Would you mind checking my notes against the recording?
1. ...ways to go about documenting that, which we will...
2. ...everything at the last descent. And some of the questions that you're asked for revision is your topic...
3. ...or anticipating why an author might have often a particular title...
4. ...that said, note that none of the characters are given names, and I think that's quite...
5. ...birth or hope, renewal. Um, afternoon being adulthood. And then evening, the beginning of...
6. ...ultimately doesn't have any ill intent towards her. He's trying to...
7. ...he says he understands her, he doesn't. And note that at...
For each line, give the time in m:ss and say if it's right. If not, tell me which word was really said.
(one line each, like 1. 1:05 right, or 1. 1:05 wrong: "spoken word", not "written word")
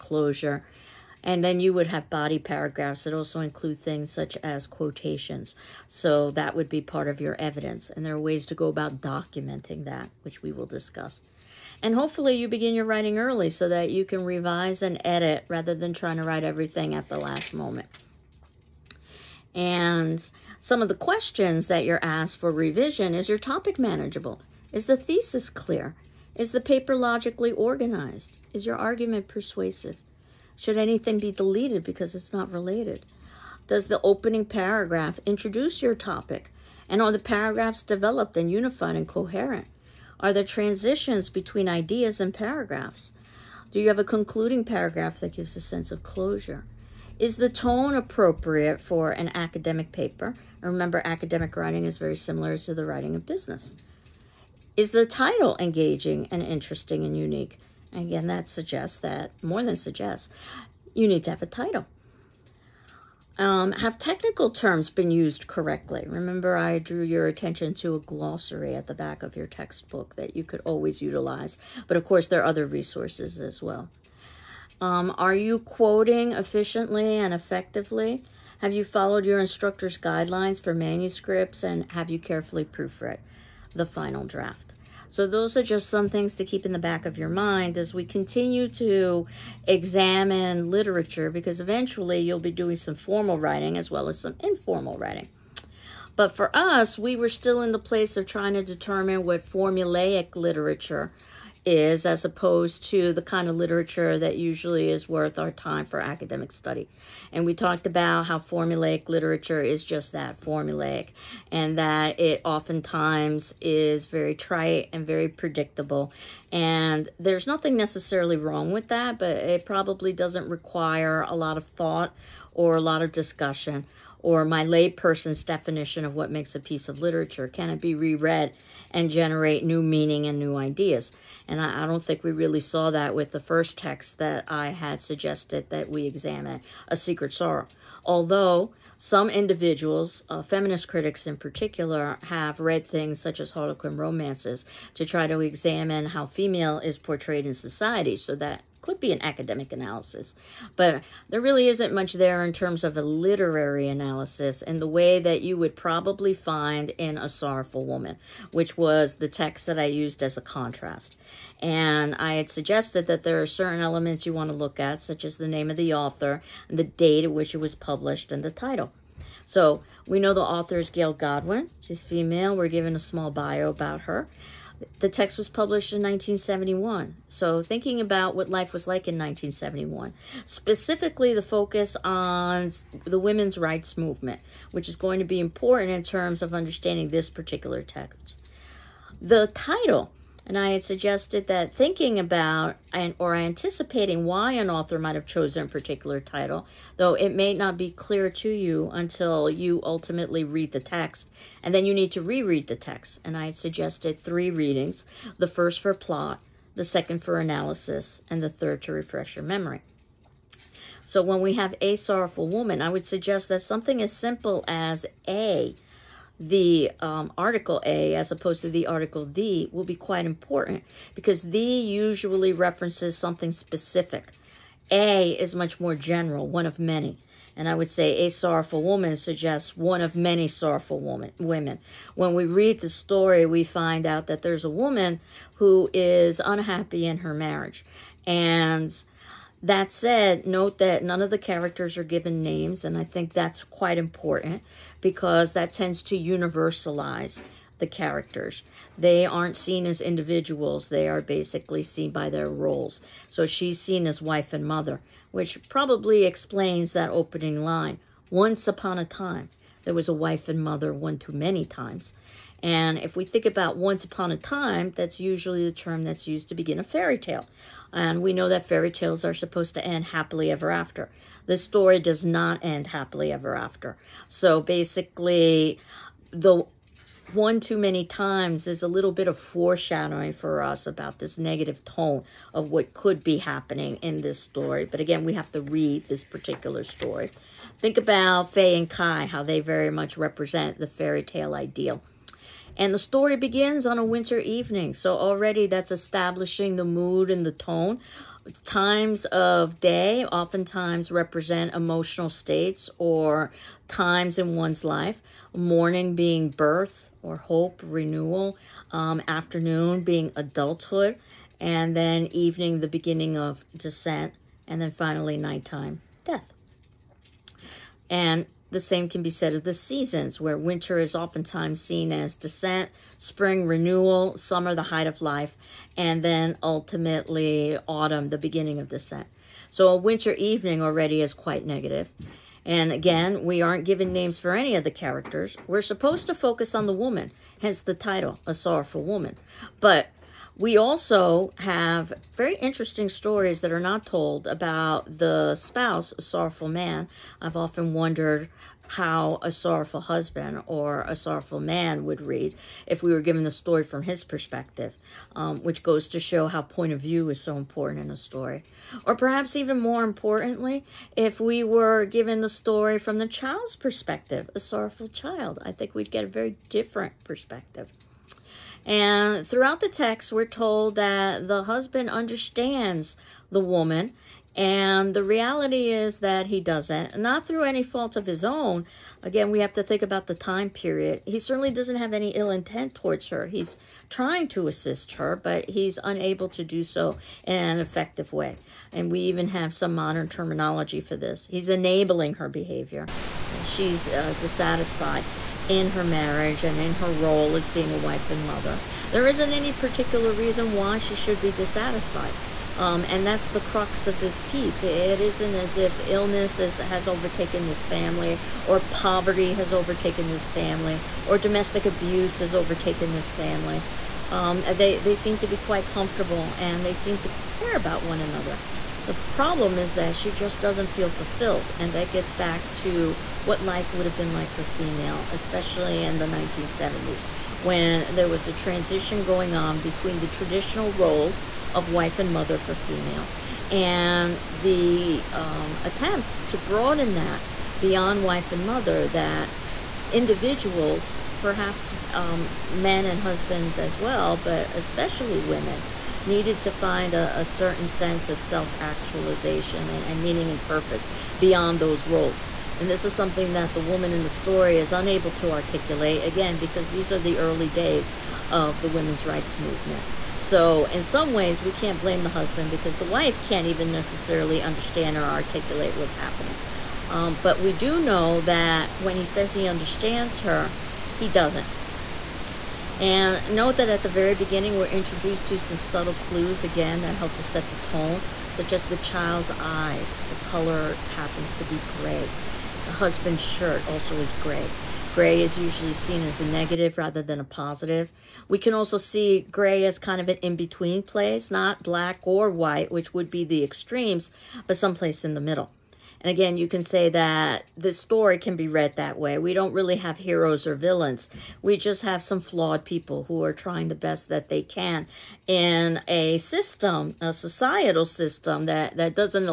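1. 0:08 right
2. 0:16 wrong: "moment", not "descent"
3. 3:13 wrong: "chosen", not "often"
4. 3:59 right
5. 5:06 right
6. 6:21 wrong: "certainly", not "ultimately"
7. 7:49 right.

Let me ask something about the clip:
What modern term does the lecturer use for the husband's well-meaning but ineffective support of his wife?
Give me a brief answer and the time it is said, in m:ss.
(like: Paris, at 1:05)
Enabling, at 6:31.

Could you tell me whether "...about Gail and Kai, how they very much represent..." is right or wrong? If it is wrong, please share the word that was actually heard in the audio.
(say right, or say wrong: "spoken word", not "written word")
wrong: "Faye", not "Gail".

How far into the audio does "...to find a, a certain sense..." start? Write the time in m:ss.
7:26.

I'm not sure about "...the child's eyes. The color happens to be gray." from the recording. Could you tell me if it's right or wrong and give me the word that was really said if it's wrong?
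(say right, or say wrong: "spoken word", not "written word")
right.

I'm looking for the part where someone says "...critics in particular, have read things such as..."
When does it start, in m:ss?
2:20.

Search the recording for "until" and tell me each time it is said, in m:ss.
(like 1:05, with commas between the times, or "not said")
3:18.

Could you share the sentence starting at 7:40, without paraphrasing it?
So, in some ways, we can't blame the husband because the wife can't even necessarily understand or articulate what's happening.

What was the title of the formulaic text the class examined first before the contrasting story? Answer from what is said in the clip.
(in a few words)
A Secret Sorrow.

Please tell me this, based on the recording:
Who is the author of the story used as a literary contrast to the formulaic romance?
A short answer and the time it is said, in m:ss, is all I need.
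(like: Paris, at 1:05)
Gail Godwin, at 2:50.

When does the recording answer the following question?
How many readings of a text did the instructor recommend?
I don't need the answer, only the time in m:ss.
3:24.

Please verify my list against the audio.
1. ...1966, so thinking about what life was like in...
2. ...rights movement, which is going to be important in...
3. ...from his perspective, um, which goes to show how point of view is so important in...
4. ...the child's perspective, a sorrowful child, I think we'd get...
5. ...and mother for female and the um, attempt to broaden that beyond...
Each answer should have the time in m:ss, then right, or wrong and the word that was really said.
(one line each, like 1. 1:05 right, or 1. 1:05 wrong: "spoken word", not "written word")
1. 2:55 wrong: "1971", not "1966"
2. 3:03 right
3. 5:53 right
4. 6:03 right
5. 7:12 right.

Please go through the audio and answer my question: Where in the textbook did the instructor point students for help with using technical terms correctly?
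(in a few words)
A glossary at the back.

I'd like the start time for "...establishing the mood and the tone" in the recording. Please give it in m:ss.
4:55.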